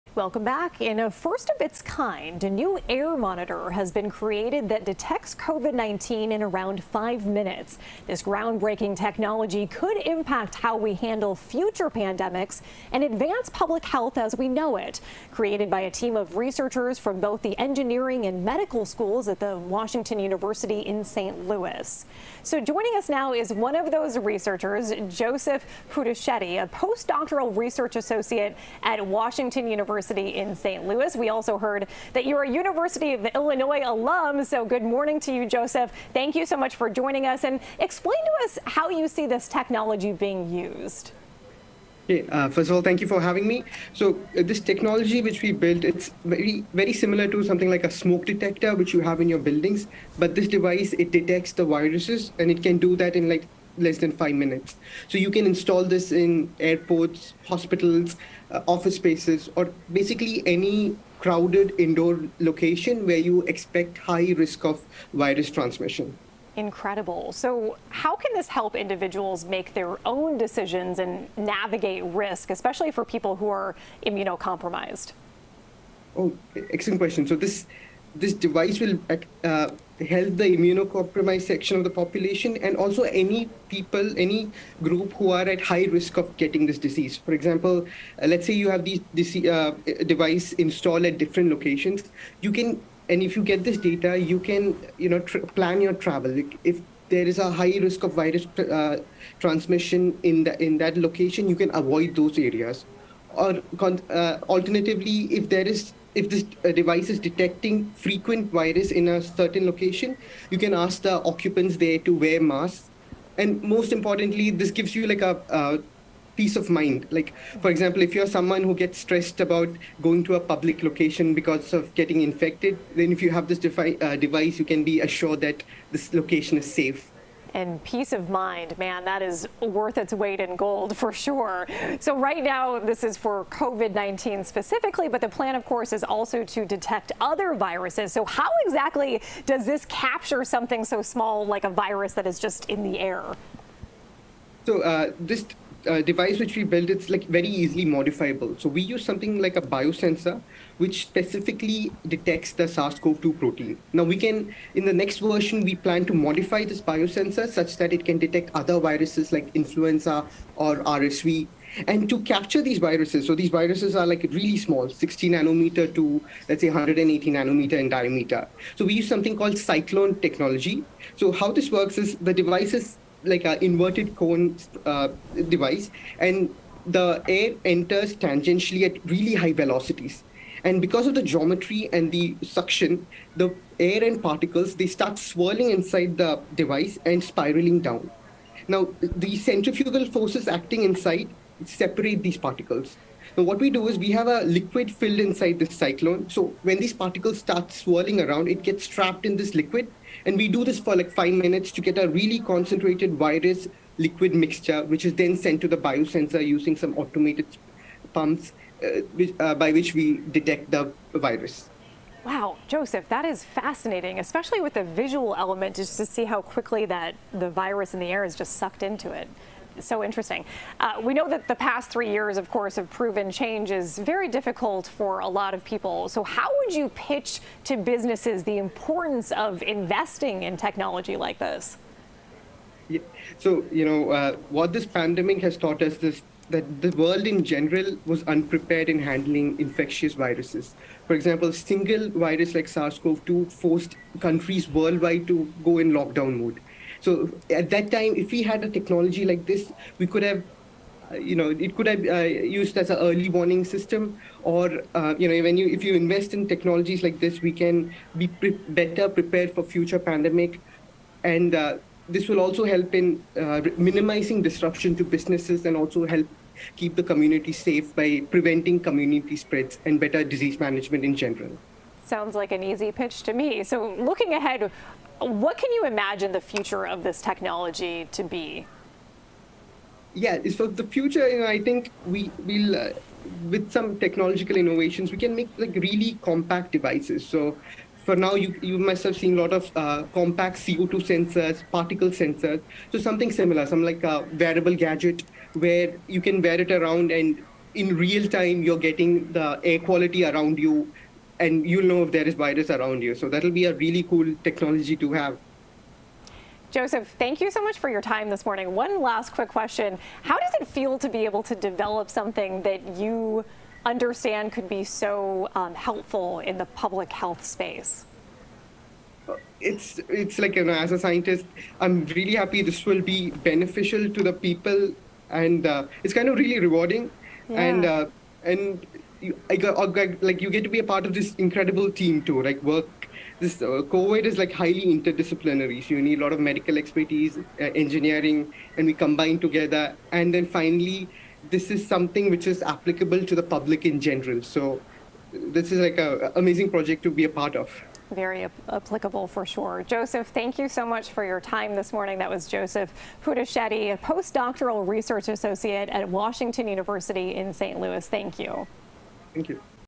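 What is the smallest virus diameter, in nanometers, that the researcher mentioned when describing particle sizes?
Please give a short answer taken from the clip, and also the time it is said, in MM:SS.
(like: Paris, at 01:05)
60 nanometers, at 02:44.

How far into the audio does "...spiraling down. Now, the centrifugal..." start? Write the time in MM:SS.
03:07.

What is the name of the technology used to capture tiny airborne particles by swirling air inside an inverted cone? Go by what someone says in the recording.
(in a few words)
cyclone technology.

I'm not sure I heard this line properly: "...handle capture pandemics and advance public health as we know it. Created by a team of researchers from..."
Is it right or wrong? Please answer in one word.
wrong.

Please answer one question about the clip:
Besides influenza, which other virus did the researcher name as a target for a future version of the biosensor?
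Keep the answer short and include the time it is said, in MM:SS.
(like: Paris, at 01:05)
RSV, at 02:40.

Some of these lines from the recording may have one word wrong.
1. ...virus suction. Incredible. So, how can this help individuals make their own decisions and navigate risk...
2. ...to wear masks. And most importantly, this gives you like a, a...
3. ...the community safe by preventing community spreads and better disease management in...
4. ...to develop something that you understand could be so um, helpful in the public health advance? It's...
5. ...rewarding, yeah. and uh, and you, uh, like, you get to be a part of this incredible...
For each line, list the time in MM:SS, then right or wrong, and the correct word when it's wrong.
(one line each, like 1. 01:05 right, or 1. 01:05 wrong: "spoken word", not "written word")
1. 01:05 wrong: "transmission", not "suction"
2. 01:51 right
3. 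04:26 right
4. 05:11 wrong: "space", not "advance"
5. 05:26 right.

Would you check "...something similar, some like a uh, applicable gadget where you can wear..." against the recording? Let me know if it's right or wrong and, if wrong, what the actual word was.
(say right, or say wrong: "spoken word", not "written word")
wrong: "wearable", not "applicable".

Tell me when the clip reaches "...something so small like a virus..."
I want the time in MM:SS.
02:20.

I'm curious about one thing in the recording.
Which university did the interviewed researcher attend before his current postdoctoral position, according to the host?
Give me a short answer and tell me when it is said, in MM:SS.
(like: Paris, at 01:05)
University of Illinois, at 00:32.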